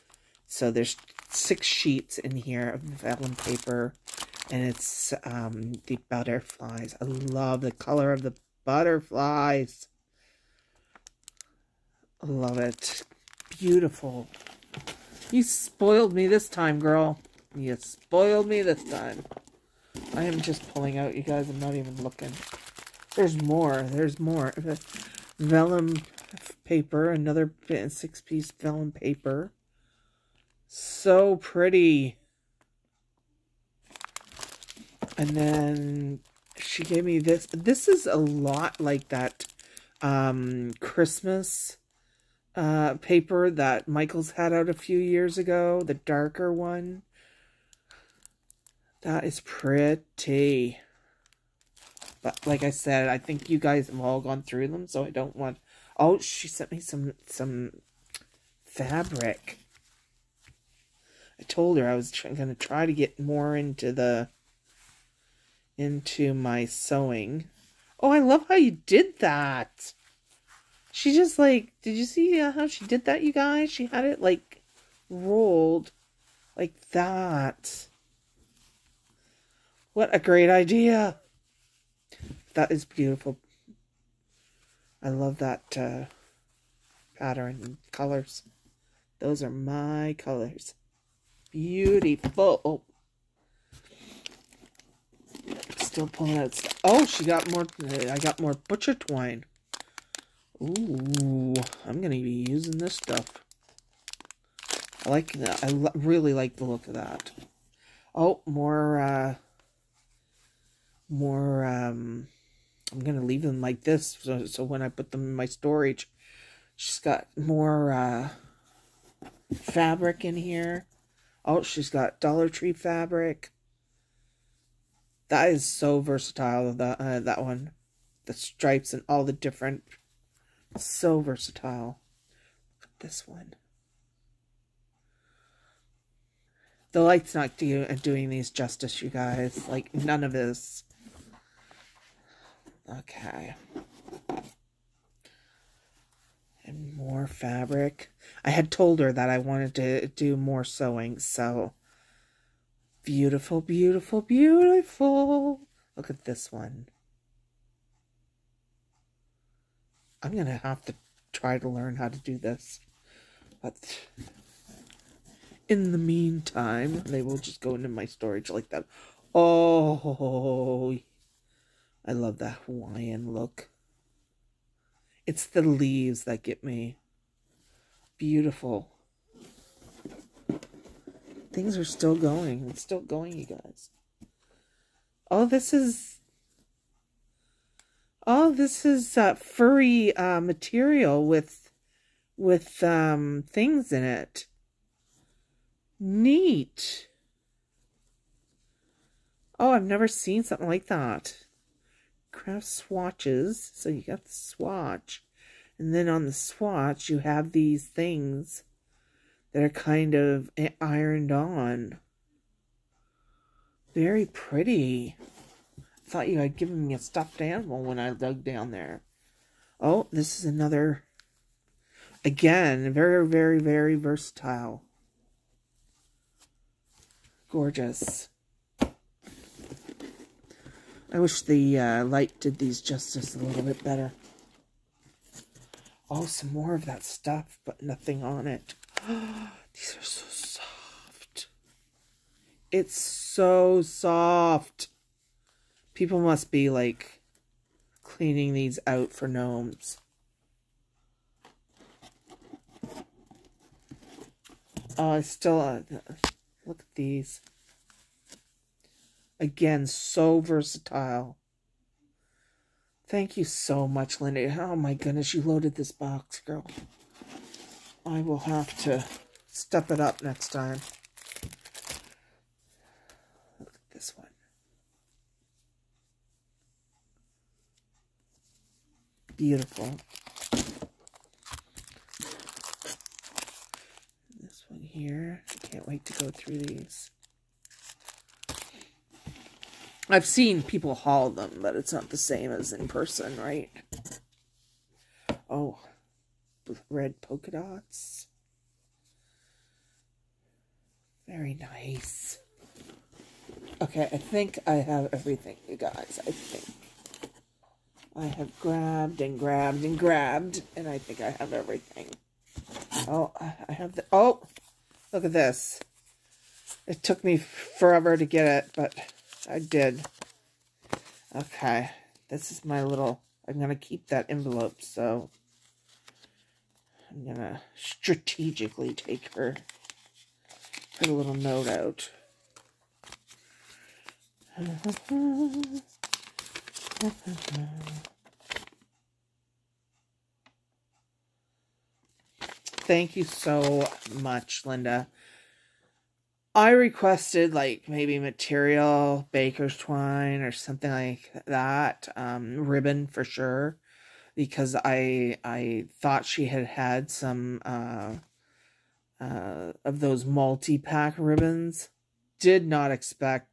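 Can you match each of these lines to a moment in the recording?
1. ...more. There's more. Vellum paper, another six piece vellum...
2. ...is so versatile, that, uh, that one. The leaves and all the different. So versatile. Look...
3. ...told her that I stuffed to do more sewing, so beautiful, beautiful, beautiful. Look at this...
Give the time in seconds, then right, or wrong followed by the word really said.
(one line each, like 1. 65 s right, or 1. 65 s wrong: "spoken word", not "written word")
1. 23 s right
2. 125 s wrong: "stripes", not "leaves"
3. 148 s wrong: "wanted", not "stuffed".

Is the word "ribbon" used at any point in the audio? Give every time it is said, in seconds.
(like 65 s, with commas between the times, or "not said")
352 s, 361 s.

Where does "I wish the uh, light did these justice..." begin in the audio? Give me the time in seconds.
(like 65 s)
231 s.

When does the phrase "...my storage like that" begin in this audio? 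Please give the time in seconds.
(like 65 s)
167 s.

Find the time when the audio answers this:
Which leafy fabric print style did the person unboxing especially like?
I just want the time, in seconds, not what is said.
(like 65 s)
172 s.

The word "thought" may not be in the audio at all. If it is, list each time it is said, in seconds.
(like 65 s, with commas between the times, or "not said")
216 s, 356 s.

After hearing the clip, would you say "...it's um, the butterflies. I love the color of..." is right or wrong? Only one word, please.
right.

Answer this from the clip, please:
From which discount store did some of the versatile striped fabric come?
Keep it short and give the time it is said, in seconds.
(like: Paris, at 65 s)
Dollar Tree, at 122 s.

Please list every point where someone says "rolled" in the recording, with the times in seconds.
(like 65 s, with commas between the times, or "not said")
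75 s.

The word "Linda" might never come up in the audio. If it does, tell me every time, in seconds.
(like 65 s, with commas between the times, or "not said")
264 s, 344 s.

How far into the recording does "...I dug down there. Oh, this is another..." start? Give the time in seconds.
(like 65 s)
217 s.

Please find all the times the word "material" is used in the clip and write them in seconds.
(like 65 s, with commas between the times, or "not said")
190 s, 348 s.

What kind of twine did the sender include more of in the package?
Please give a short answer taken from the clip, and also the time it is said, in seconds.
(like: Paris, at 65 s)
Butcher twine, at 98 s.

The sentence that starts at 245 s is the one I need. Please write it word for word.
People must be like cleaning these out for gnomes.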